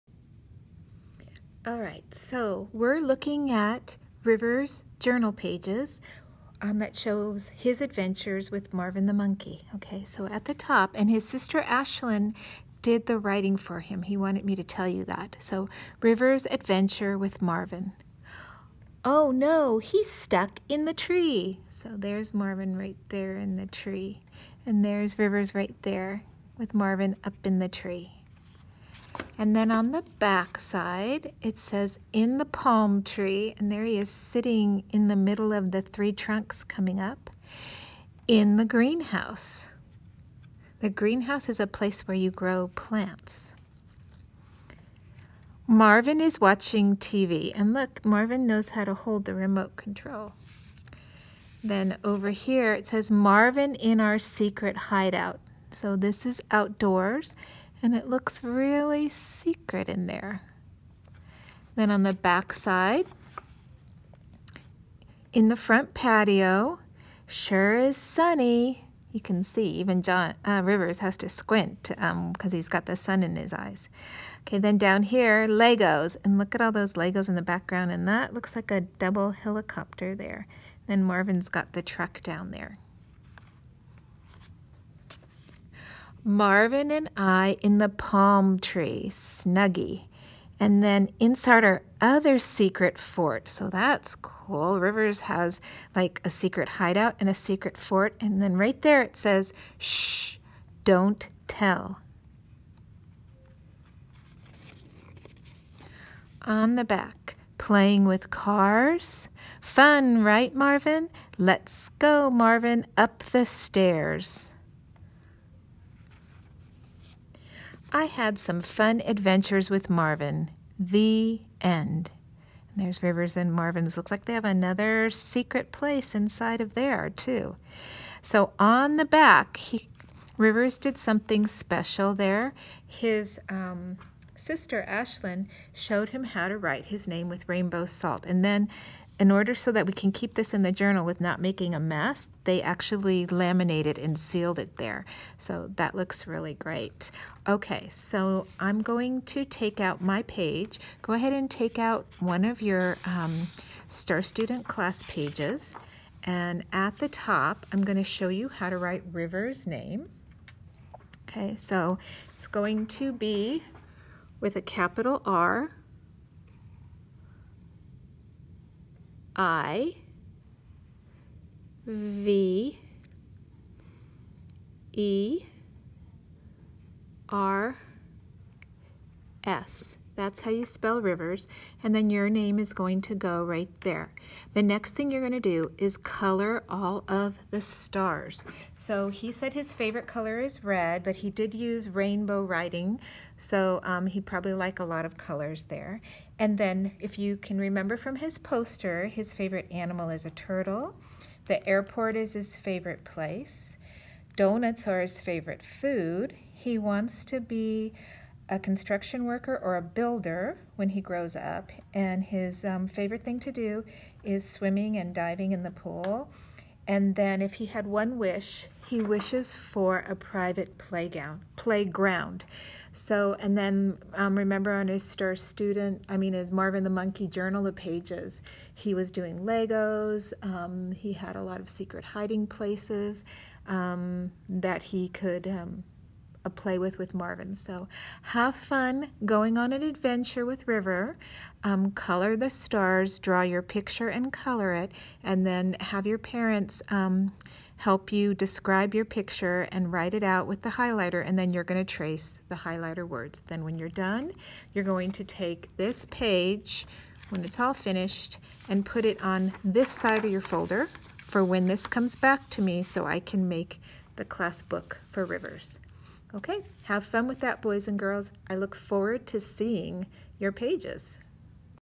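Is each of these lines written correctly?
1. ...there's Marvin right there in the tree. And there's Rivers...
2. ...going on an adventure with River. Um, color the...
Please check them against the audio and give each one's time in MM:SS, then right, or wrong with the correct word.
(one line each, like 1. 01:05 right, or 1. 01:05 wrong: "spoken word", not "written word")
1. 00:21 right
2. 03:59 right.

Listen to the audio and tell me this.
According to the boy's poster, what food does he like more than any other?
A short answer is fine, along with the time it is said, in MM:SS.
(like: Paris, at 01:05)
Donuts, at 03:24.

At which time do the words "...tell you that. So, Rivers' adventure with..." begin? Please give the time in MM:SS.
00:14.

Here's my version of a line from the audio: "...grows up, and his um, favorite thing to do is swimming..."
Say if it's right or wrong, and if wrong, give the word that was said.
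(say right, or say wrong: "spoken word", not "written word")
right.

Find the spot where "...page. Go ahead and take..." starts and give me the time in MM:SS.
02:30.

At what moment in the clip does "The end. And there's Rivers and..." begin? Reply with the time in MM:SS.
02:00.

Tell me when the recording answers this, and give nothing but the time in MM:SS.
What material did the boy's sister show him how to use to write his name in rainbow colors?
02:17.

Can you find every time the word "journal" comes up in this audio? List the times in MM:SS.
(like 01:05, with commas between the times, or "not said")
00:04, 02:20, 03:47.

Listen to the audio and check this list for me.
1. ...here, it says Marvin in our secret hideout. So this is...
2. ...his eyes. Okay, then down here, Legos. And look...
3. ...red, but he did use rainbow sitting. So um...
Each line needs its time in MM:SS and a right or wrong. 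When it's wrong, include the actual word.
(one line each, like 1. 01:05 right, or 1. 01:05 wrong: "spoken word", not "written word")
1. 00:52 right
2. 01:13 right
3. 03:10 wrong: "writing", not "sitting".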